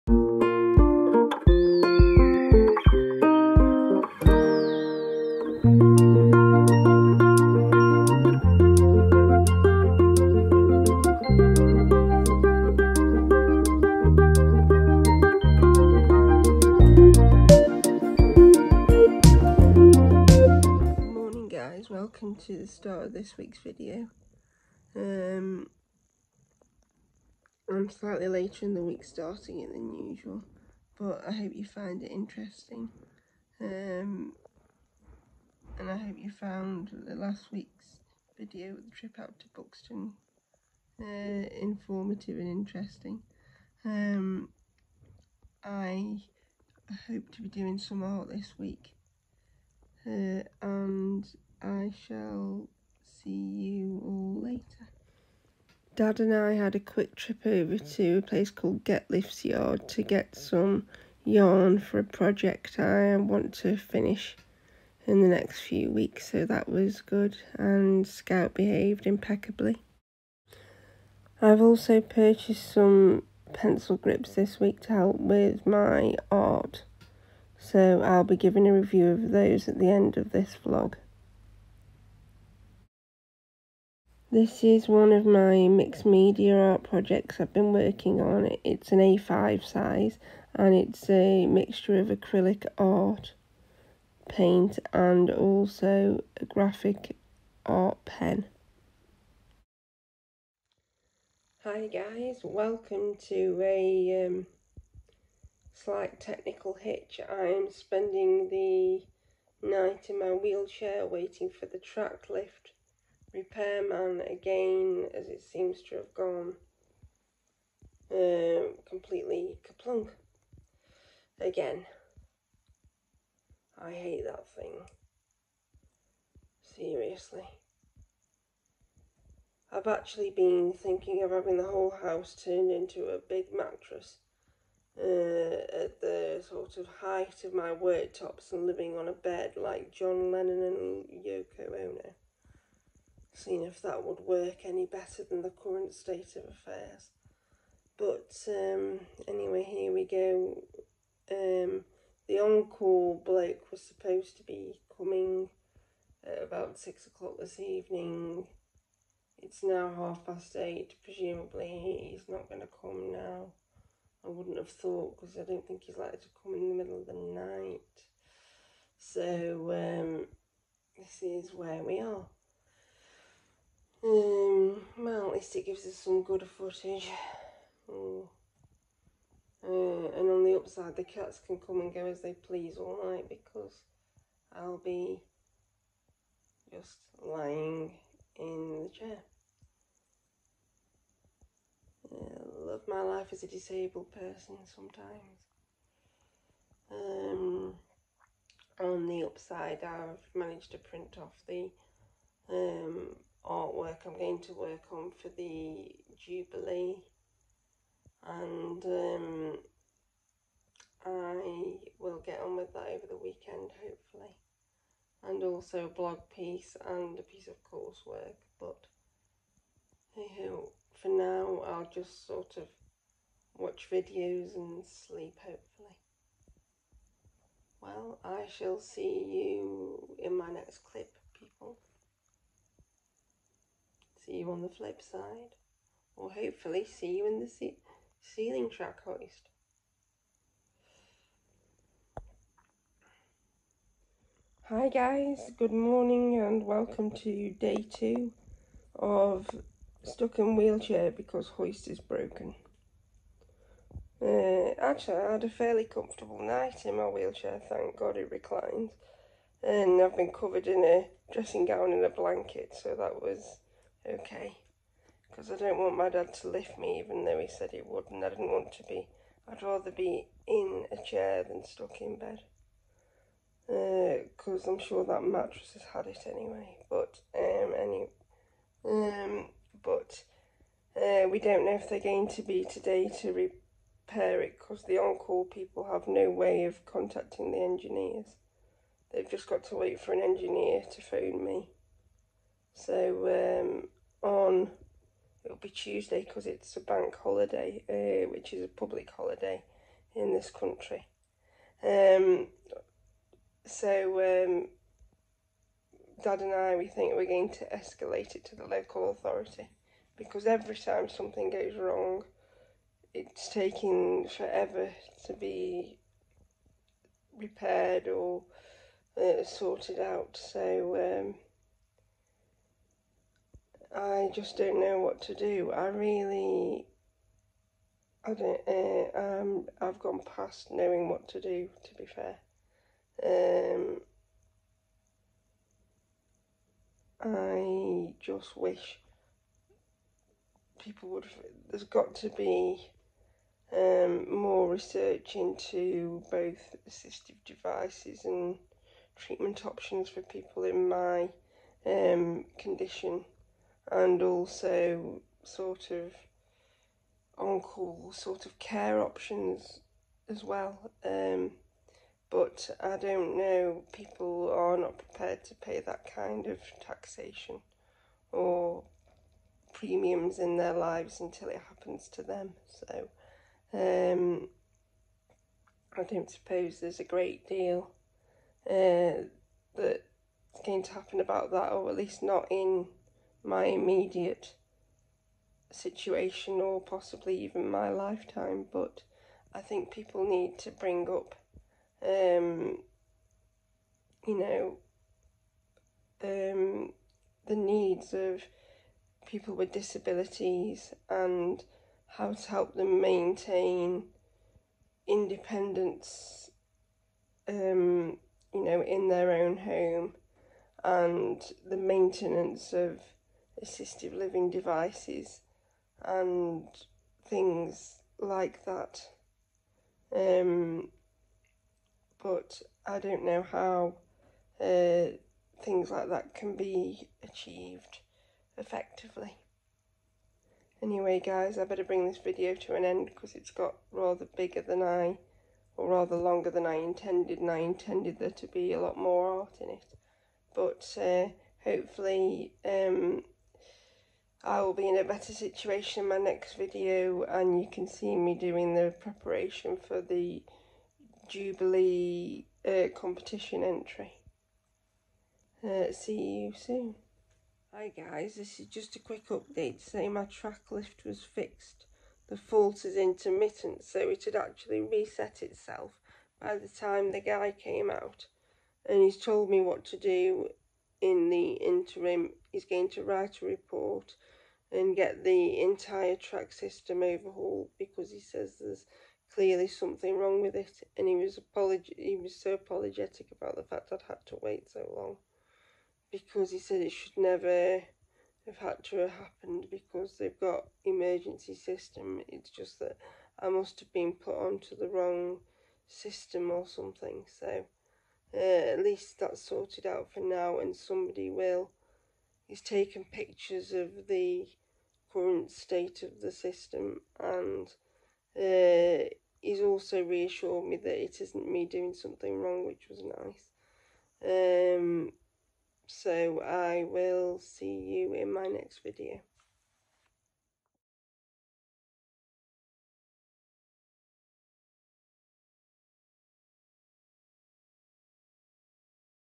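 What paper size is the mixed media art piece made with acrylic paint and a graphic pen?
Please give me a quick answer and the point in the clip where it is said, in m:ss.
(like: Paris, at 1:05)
A5, at 1:28.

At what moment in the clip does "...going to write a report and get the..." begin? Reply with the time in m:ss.
7:52.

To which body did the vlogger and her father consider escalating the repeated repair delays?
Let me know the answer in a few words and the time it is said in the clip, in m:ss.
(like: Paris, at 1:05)
the local authority, at 5:08.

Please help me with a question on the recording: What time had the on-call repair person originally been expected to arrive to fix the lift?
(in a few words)
6 o'clock.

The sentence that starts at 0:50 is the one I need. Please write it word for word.
Uh, and I shall see you all later.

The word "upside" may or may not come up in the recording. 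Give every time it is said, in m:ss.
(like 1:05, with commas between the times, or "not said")
3:00, 3:19.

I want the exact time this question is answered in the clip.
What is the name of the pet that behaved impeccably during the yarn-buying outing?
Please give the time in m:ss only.
1:08.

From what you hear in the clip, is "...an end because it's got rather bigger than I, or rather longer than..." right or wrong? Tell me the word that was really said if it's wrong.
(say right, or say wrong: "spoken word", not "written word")
right.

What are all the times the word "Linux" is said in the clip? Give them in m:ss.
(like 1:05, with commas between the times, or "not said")
not said.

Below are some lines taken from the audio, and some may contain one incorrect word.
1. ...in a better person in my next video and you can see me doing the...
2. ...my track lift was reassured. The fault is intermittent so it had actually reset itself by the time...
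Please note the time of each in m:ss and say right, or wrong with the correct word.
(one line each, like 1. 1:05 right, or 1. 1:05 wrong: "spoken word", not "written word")
1. 7:24 wrong: "situation", not "person"
2. 7:40 wrong: "fixed", not "reassured".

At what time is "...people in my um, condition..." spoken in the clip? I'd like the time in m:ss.
5:50.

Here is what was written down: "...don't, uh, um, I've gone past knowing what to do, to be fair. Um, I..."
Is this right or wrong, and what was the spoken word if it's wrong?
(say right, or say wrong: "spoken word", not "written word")
right.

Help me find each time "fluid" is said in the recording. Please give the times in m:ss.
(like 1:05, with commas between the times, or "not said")
not said.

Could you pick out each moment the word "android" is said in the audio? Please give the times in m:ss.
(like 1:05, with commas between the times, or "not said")
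not said.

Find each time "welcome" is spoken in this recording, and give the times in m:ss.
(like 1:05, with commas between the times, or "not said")
0:22, 1:42, 4:06.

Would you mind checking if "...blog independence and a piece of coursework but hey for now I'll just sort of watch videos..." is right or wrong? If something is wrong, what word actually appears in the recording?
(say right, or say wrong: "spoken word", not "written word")
wrong: "piece", not "independence".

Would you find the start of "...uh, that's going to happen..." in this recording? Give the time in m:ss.
6:18.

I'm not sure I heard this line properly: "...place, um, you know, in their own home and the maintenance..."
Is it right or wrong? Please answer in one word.
wrong.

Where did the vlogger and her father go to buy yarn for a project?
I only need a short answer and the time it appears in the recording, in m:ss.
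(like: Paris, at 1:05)
Getliff's Yard, at 0:58.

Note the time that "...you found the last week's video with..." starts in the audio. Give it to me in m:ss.
0:36.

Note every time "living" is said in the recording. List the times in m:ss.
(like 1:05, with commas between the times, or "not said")
2:18, 6:54.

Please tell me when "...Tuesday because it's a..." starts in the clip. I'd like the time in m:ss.
4:55.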